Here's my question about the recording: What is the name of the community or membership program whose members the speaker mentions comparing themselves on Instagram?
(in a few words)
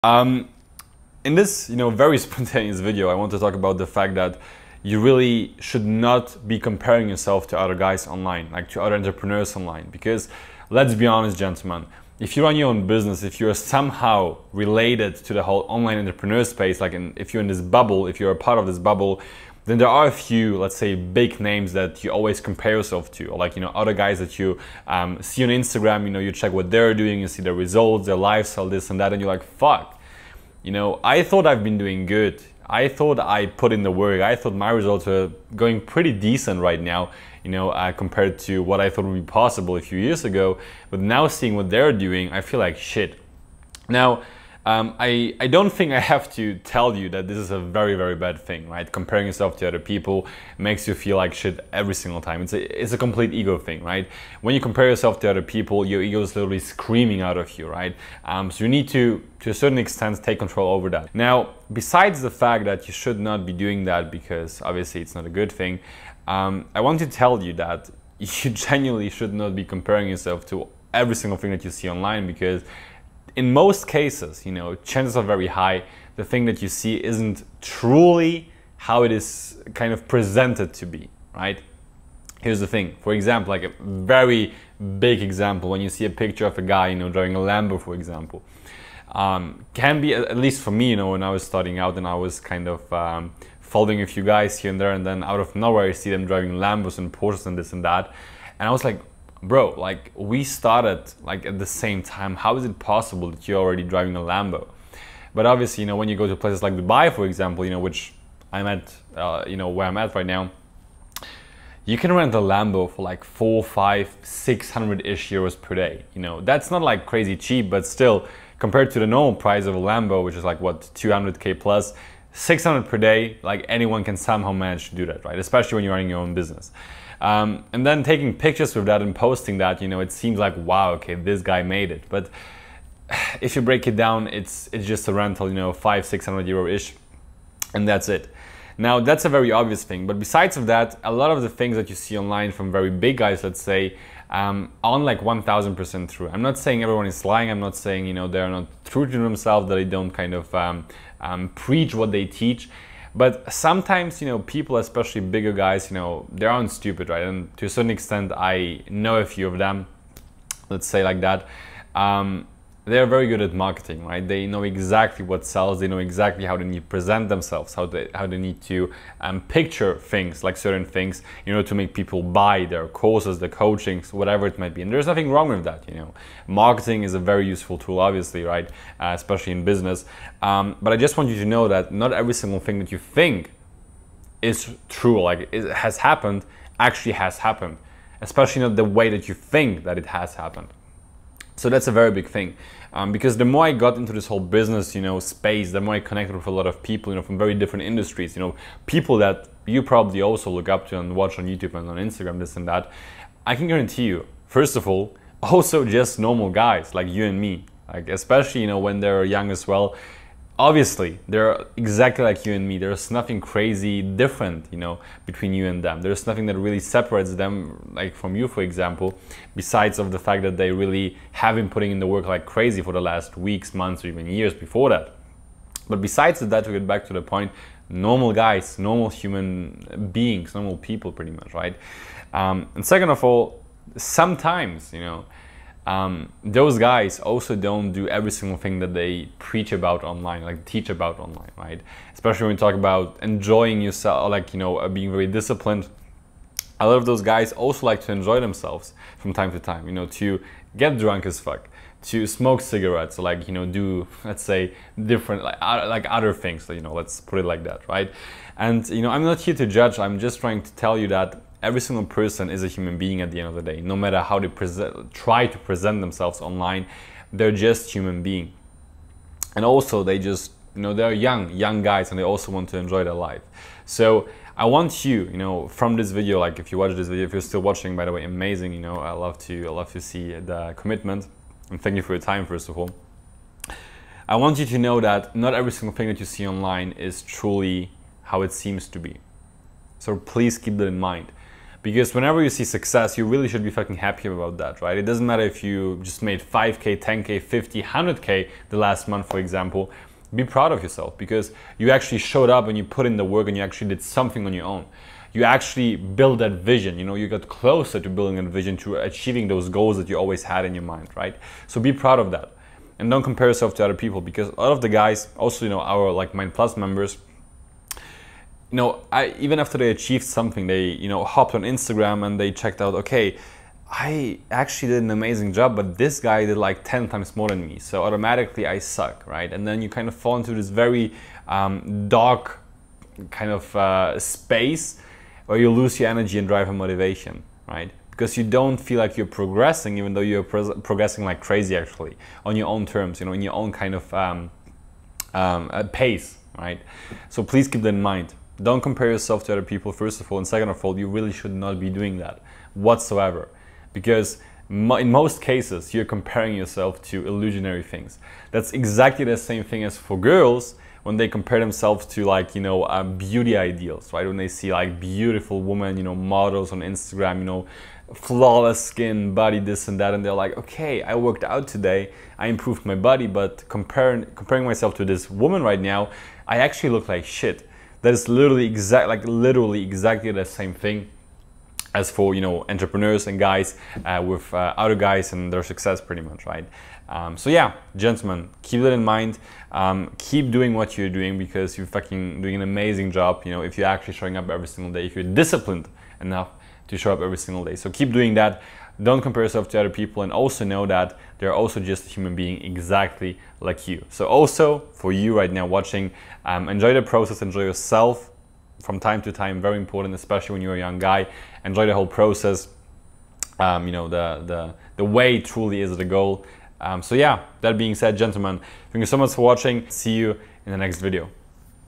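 Mind Plus.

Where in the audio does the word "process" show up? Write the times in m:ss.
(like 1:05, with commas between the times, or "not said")
6:47, 6:52.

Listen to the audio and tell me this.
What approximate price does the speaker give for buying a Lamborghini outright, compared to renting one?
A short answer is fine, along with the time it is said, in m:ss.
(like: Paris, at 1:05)
200k plus, at 2:00.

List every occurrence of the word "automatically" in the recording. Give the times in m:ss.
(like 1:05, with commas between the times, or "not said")
5:28.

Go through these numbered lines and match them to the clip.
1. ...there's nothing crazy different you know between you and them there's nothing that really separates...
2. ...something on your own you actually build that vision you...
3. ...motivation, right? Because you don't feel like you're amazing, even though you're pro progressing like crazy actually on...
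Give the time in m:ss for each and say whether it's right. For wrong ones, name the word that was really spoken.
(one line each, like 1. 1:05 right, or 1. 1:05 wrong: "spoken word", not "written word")
1. 3:32 right
2. 5:04 right
3. 5:36 wrong: "progressing", not "amazing".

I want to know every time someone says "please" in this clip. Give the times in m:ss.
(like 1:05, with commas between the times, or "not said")
4:50, 5:47.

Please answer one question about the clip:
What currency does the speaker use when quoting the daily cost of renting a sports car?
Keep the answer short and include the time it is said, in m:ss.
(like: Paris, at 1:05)
euros, at 1:55.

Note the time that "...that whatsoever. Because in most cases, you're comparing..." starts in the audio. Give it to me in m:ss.
5:52.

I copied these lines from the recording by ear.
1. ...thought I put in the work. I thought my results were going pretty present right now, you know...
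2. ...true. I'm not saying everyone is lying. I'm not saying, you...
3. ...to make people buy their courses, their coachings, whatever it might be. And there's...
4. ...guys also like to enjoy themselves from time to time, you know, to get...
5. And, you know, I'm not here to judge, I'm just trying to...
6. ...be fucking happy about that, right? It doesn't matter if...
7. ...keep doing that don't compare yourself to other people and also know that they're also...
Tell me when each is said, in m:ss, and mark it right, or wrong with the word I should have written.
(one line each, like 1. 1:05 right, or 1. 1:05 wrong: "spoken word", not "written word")
1. 0:32 wrong: "decent", not "present"
2. 2:26 right
3. 2:51 right
4. 4:07 right
5. 4:18 right
6. 4:53 right
7. 6:37 right.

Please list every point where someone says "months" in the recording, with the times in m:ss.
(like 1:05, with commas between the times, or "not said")
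3:43, 4:59.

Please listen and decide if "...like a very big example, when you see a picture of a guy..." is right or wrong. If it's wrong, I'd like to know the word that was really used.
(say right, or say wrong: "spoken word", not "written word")
right.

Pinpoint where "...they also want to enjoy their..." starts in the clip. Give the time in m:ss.
4:32.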